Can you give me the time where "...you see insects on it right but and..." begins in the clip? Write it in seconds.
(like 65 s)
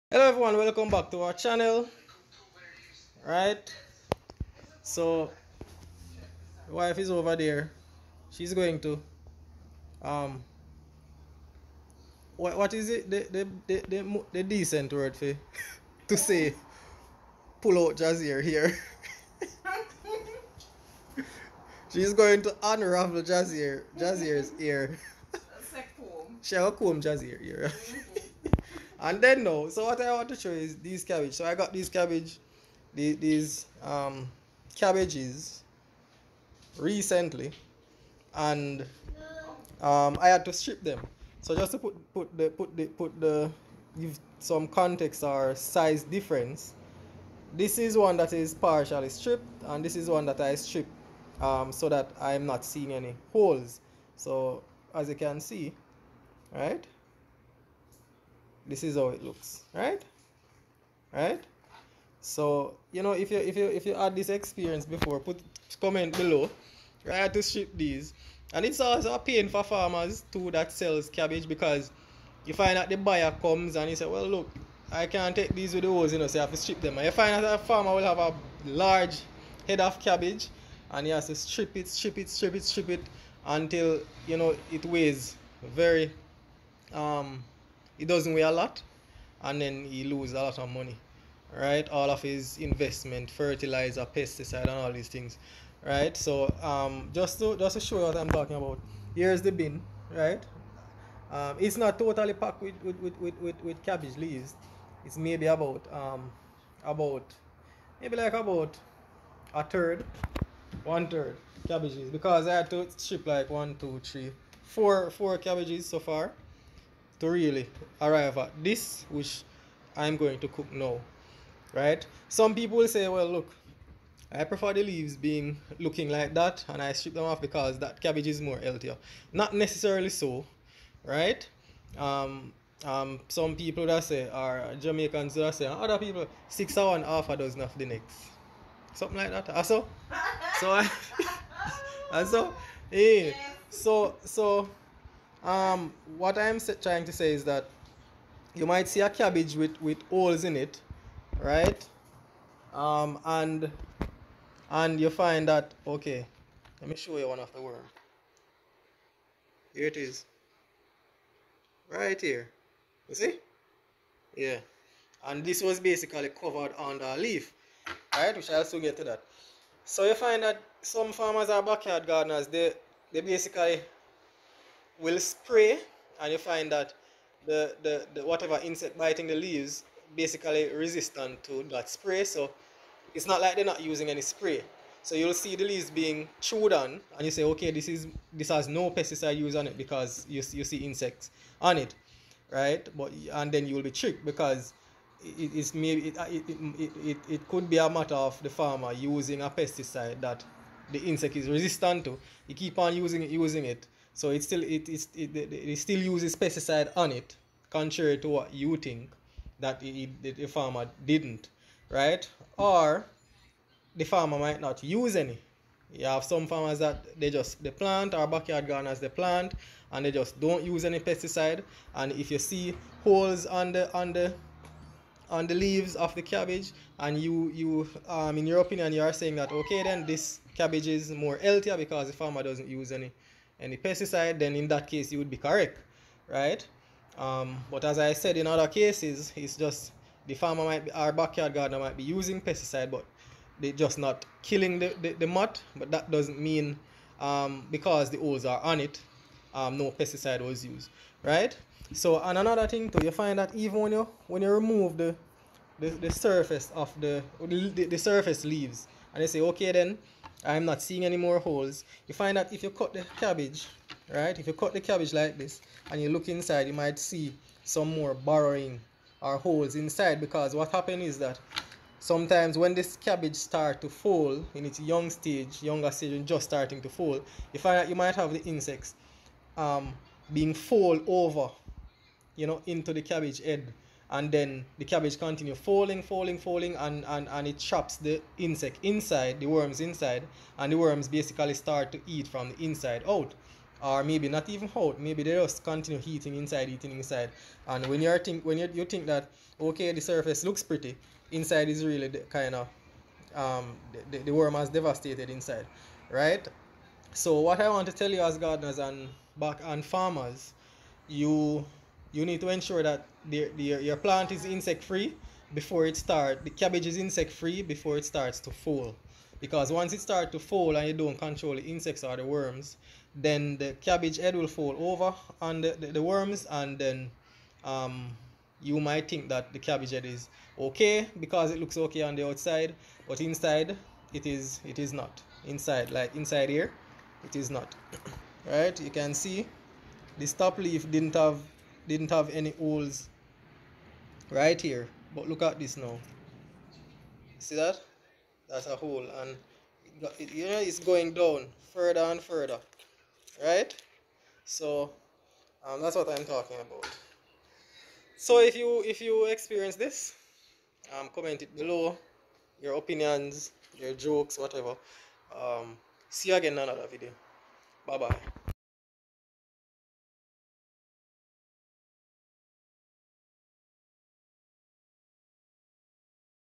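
190 s.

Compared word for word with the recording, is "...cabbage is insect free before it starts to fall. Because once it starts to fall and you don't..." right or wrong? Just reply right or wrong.
right.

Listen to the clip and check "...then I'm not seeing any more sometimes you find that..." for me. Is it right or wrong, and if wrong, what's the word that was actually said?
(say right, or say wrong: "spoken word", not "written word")
wrong: "holes", not "sometimes".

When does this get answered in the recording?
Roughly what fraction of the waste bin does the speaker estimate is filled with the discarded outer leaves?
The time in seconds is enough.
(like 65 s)
110 s.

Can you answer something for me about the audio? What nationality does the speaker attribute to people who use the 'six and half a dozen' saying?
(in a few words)
Jamaicans.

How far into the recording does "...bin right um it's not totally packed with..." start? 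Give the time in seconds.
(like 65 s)
99 s.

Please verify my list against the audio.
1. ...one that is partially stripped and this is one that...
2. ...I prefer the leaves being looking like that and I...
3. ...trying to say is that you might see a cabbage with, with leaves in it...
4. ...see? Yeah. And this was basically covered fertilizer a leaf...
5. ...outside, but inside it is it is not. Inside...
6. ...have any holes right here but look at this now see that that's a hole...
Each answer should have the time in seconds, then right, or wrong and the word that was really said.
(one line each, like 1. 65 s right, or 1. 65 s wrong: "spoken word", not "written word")
1. 47 s right
2. 124 s right
3. 146 s wrong: "holes", not "leaves"
4. 163 s wrong: "under", not "fertilizer"
5. 332 s right
6. 342 s right.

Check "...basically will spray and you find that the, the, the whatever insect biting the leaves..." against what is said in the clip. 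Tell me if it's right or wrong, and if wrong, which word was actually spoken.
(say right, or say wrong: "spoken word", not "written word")
right.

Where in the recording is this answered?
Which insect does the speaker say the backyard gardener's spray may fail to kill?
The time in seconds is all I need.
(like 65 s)
245 s.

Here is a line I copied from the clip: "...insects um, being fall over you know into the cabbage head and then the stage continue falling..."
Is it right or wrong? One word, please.
wrong.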